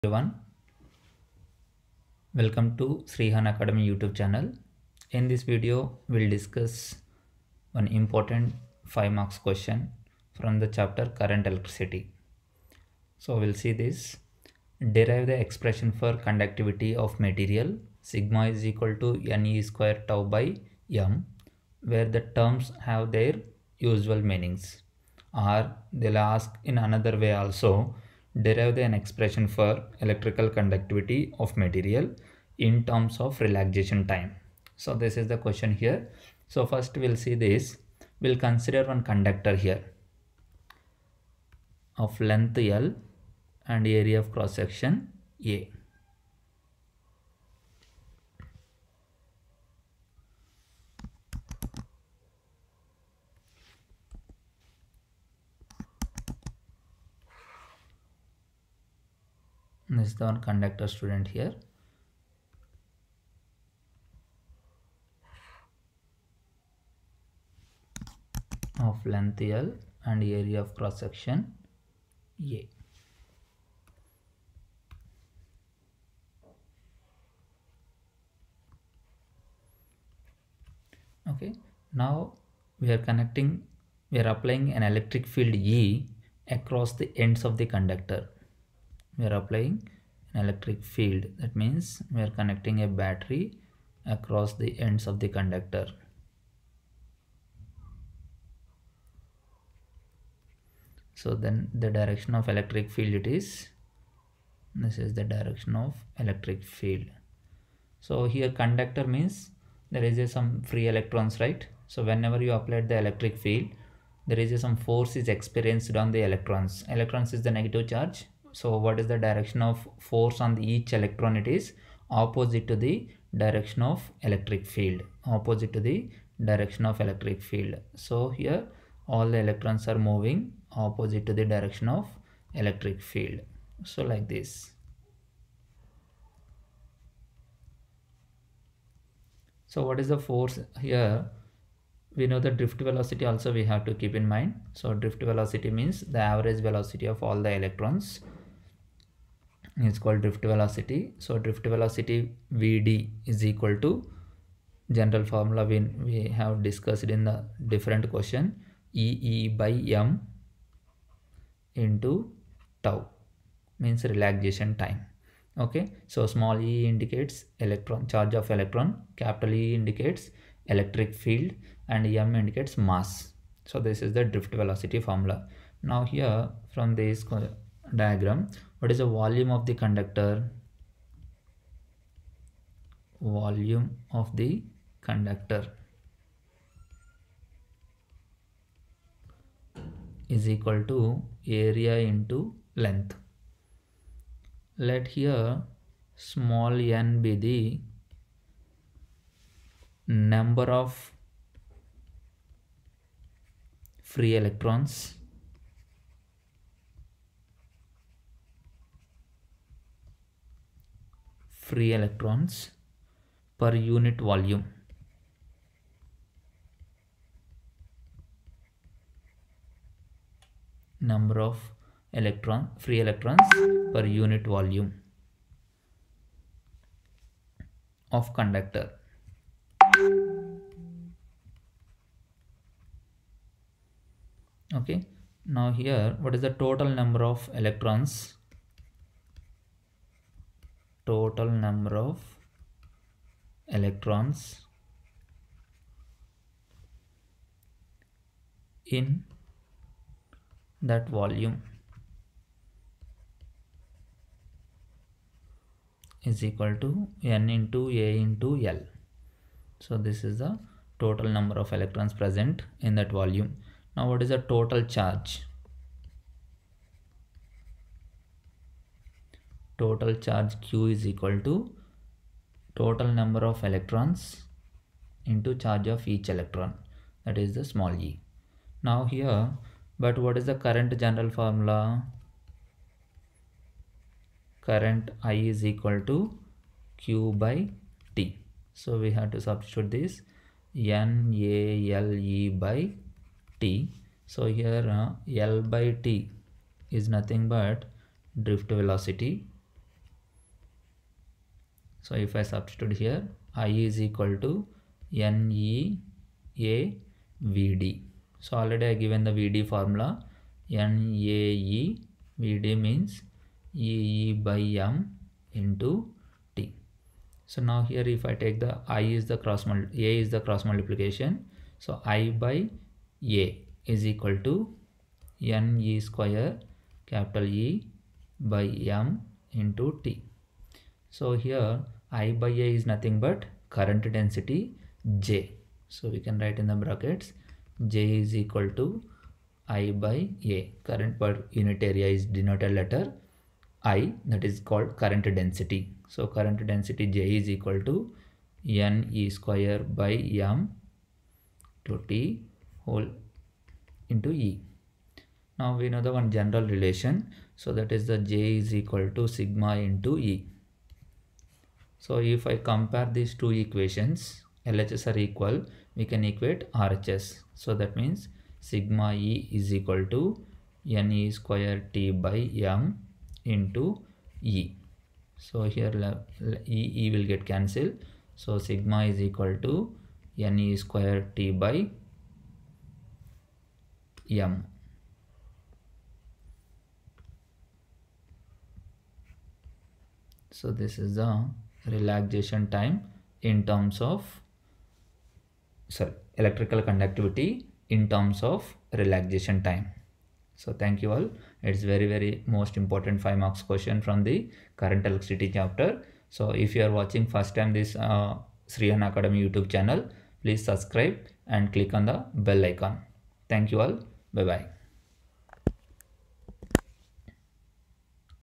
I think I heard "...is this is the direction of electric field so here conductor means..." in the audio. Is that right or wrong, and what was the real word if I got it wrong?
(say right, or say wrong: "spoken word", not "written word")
right.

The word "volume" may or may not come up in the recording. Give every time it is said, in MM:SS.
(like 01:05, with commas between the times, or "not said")
02:59, 03:03, 03:34, 03:44, 04:11, 04:23.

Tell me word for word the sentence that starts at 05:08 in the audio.
So already I given the VD formula.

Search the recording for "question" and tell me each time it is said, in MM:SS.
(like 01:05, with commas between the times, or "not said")
00:09, 00:35, 02:38, 06:43.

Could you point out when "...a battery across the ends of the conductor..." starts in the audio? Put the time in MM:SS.
01:32.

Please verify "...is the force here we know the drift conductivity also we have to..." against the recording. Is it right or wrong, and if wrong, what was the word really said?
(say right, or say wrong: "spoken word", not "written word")
wrong: "velocity", not "conductivity".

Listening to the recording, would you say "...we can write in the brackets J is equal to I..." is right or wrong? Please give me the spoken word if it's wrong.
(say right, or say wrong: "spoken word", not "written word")
right.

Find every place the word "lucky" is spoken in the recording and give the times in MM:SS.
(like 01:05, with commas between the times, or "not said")
not said.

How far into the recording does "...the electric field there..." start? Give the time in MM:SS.
01:52.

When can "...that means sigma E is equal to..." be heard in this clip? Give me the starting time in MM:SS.
06:07.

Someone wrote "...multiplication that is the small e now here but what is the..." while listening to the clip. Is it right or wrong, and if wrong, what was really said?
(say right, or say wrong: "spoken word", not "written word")
wrong: "electron", not "multiplication".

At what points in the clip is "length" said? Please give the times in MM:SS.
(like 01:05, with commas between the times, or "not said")
00:42, 01:09, 03:12.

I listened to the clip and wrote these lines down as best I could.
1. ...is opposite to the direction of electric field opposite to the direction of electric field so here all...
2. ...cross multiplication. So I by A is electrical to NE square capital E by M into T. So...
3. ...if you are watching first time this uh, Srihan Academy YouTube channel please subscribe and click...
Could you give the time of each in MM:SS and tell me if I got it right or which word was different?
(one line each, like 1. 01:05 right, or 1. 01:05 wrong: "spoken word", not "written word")
1. 02:01 right
2. 05:20 wrong: "equal", not "electrical"
3. 06:46 right.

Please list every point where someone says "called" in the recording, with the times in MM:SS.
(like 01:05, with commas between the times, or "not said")
02:29, 05:44.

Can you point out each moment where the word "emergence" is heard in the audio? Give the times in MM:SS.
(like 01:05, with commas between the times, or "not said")
not said.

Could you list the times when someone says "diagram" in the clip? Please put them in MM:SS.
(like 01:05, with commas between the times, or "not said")
02:57.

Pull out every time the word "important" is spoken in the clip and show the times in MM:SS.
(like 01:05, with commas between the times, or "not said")
00:07, 06:42.